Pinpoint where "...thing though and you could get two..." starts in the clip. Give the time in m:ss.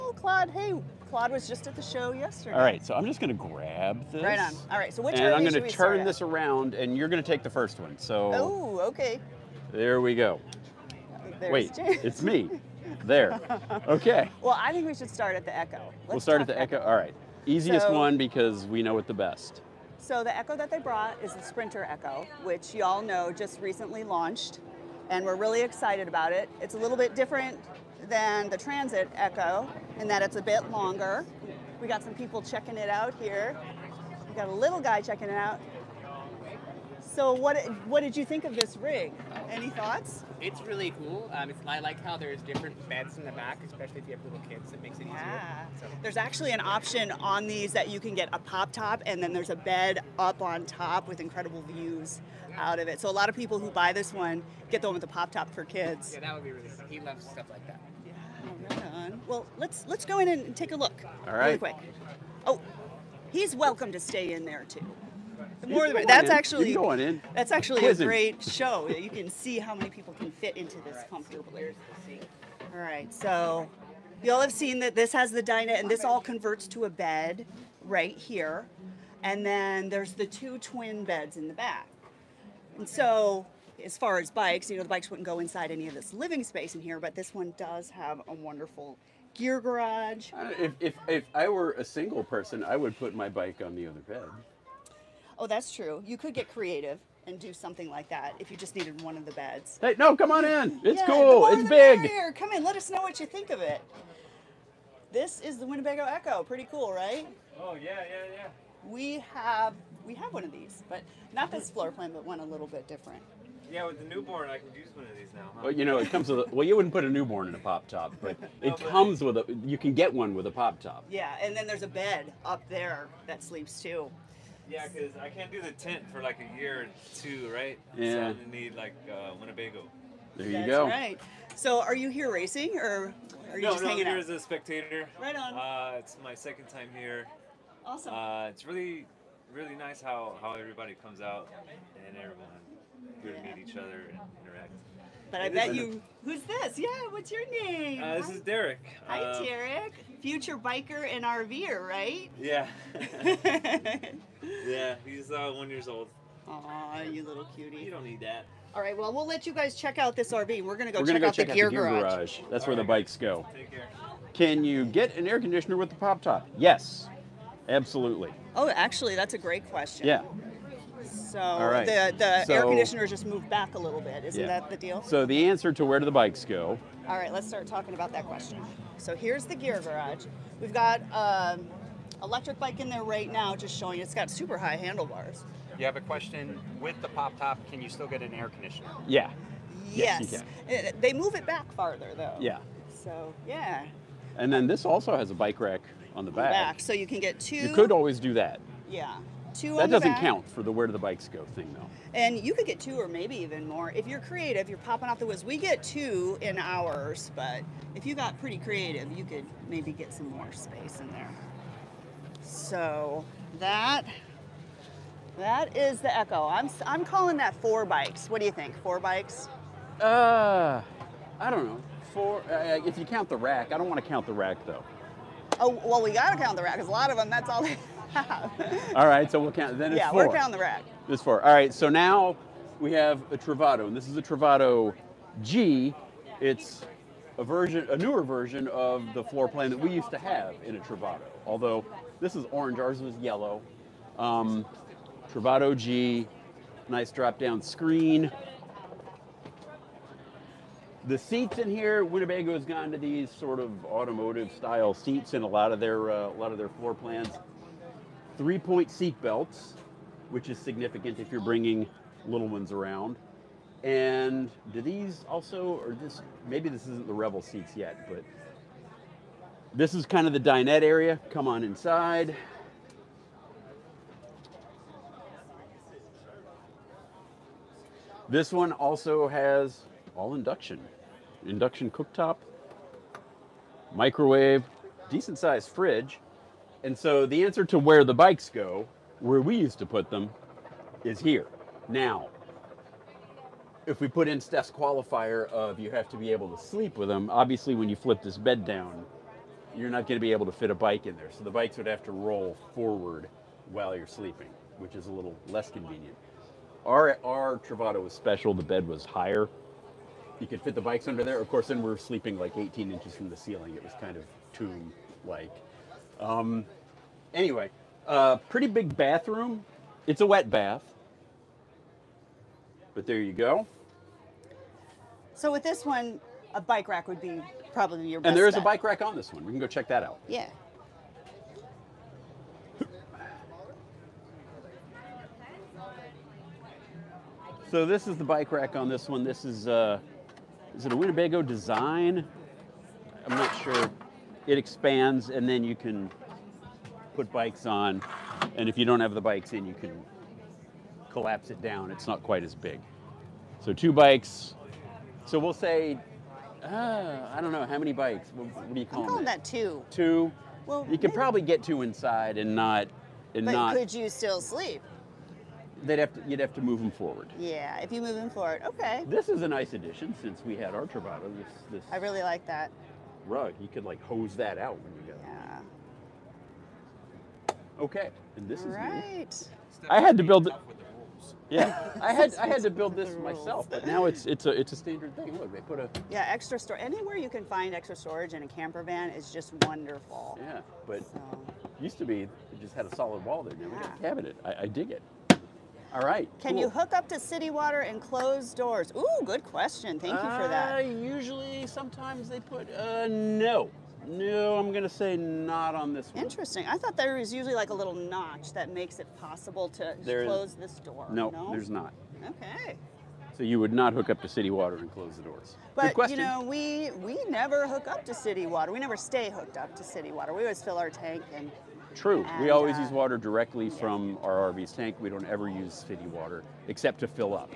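3:21.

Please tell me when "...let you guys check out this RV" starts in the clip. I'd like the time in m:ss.
2:39.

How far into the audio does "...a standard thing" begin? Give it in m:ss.
6:24.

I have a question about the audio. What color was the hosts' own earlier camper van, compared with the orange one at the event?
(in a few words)
yellow.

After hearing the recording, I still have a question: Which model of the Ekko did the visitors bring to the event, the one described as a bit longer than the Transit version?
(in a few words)
Sprinter Ekko.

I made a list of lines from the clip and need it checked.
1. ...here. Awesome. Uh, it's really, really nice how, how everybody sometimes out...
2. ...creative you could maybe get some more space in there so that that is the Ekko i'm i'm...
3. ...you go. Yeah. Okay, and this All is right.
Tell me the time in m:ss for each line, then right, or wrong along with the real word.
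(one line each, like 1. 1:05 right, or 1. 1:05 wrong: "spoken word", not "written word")
1. 2:16 wrong: "comes", not "sometimes"
2. 3:28 right
3. 6:14 right.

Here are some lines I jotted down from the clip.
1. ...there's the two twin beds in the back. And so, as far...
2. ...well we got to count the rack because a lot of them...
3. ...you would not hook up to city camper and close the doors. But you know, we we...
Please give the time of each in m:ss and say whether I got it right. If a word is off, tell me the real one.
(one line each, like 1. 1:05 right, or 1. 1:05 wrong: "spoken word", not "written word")
1. 1:19 right
2. 3:45 right
3. 6:53 wrong: "water", not "camper".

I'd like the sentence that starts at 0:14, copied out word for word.
well, I think we should start at the Ekko.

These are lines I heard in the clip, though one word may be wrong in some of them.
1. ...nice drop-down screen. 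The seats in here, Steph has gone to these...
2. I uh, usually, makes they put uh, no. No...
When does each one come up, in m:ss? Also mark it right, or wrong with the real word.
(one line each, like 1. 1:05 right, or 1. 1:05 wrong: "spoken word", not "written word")
1. 4:06 wrong: "Winnebago", not "Steph"
2. 6:40 wrong: "sometimes", not "makes".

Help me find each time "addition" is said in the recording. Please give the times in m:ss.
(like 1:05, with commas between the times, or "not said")
6:09.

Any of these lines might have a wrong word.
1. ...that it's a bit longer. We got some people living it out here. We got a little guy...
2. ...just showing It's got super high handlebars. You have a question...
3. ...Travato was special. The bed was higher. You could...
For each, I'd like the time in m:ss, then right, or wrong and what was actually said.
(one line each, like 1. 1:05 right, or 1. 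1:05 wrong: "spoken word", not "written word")
1. 0:30 wrong: "checking", not "living"
2. 3:03 right
3. 5:07 right.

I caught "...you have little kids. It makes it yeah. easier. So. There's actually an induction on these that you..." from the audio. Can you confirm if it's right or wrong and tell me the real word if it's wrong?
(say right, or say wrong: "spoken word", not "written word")
wrong: "option", not "induction".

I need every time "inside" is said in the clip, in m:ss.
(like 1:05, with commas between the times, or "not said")
1:25, 4:31, 6:01.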